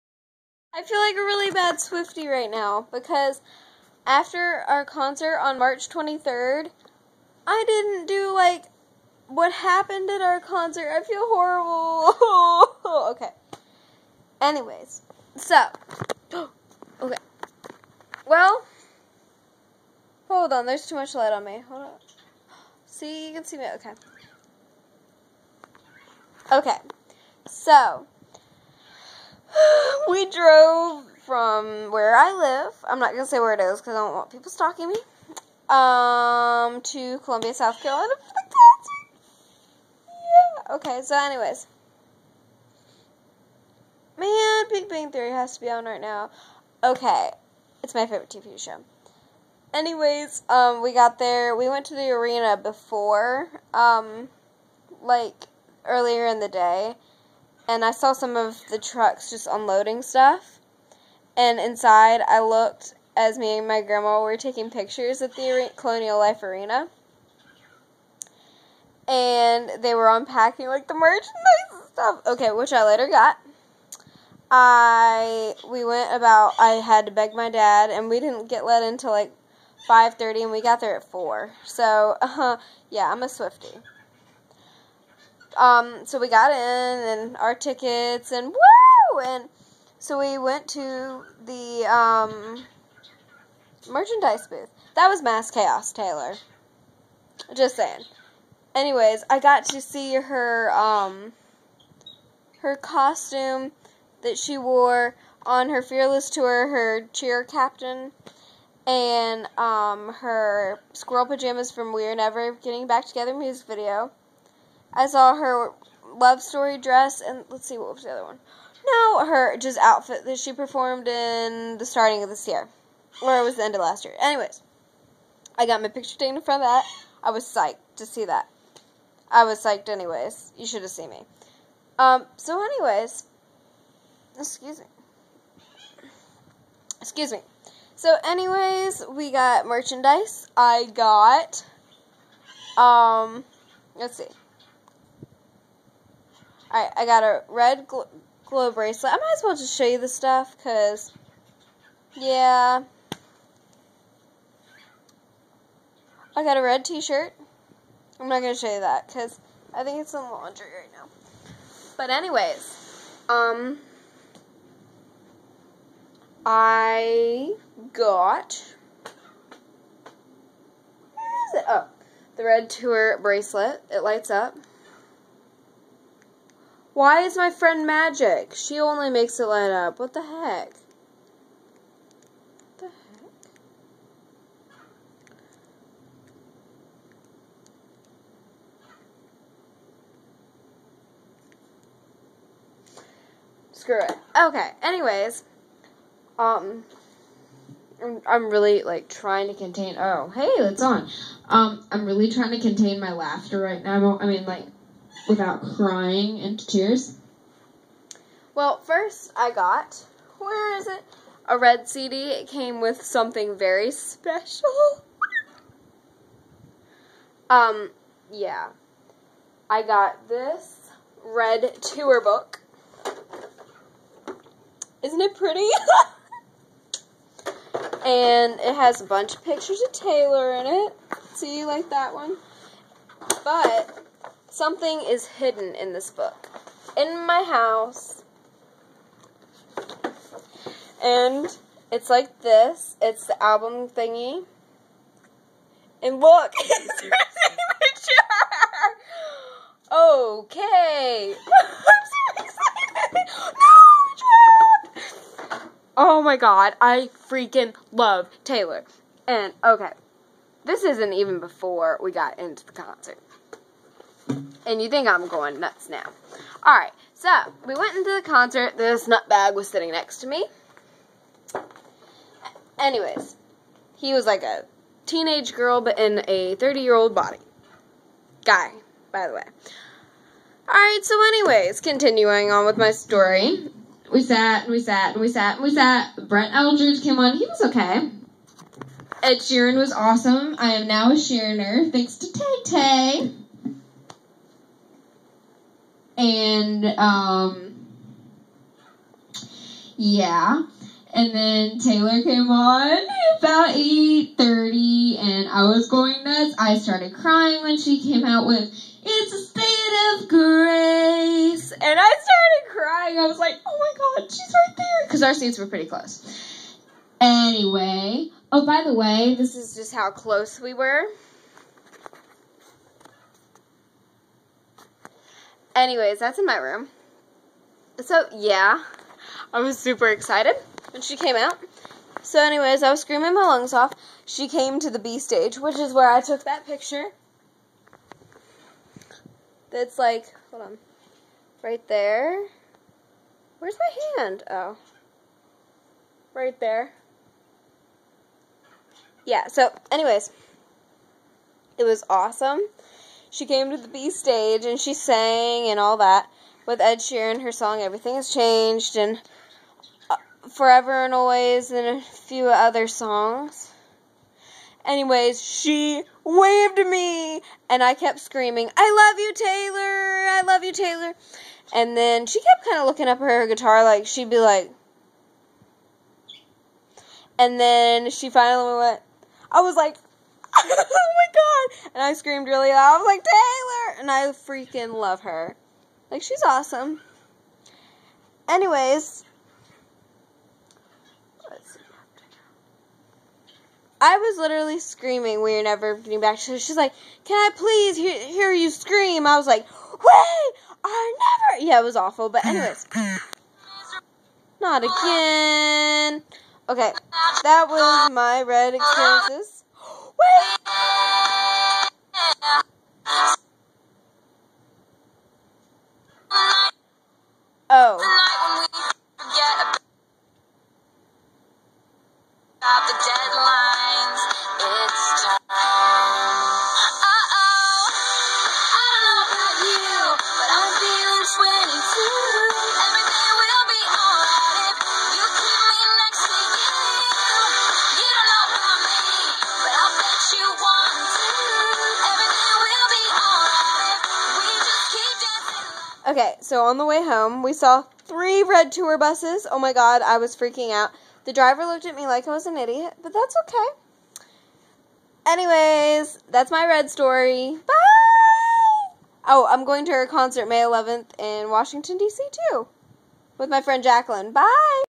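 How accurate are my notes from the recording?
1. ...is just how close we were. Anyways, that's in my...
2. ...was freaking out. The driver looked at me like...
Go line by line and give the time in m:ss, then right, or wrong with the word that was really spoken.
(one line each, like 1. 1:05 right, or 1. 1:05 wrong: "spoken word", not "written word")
1. 5:19 right
2. 7:30 right.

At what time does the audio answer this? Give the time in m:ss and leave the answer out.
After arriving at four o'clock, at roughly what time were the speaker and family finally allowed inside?
1:19.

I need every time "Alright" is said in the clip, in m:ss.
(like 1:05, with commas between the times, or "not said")
4:26, 4:40.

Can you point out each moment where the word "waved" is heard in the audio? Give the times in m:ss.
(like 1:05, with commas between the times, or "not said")
6:06.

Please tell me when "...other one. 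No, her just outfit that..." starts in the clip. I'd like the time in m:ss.
1:58.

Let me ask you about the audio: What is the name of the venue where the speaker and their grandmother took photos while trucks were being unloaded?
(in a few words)
Colonial Life Arena.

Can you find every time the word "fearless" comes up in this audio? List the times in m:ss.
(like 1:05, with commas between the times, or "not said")
1:45.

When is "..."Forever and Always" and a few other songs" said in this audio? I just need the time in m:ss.
6:00.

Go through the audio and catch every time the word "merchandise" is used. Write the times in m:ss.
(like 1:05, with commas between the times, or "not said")
1:10, 1:33, 2:19.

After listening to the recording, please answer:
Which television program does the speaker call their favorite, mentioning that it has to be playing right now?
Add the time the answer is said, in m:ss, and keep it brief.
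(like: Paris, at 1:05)
Big Bang Theory, at 0:44.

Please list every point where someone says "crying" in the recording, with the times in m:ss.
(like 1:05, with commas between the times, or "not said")
3:25, 5:07, 5:12.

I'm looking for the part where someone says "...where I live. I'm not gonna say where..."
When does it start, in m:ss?
0:31.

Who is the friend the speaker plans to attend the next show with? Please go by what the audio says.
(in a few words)
Jacqueline.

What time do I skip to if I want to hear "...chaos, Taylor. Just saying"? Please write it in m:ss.
1:35.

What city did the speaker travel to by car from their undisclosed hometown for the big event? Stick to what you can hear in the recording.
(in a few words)
Columbia, South Carolina.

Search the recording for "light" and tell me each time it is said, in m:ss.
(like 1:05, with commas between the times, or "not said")
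0:21, 2:54, 2:59.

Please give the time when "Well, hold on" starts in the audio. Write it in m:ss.
0:18.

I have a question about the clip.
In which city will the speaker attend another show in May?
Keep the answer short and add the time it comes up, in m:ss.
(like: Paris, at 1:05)
Washington, D.C., at 7:41.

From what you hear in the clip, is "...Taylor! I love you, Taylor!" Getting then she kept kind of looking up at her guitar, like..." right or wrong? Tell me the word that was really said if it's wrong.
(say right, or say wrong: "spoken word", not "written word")
wrong: "And", not "Getting".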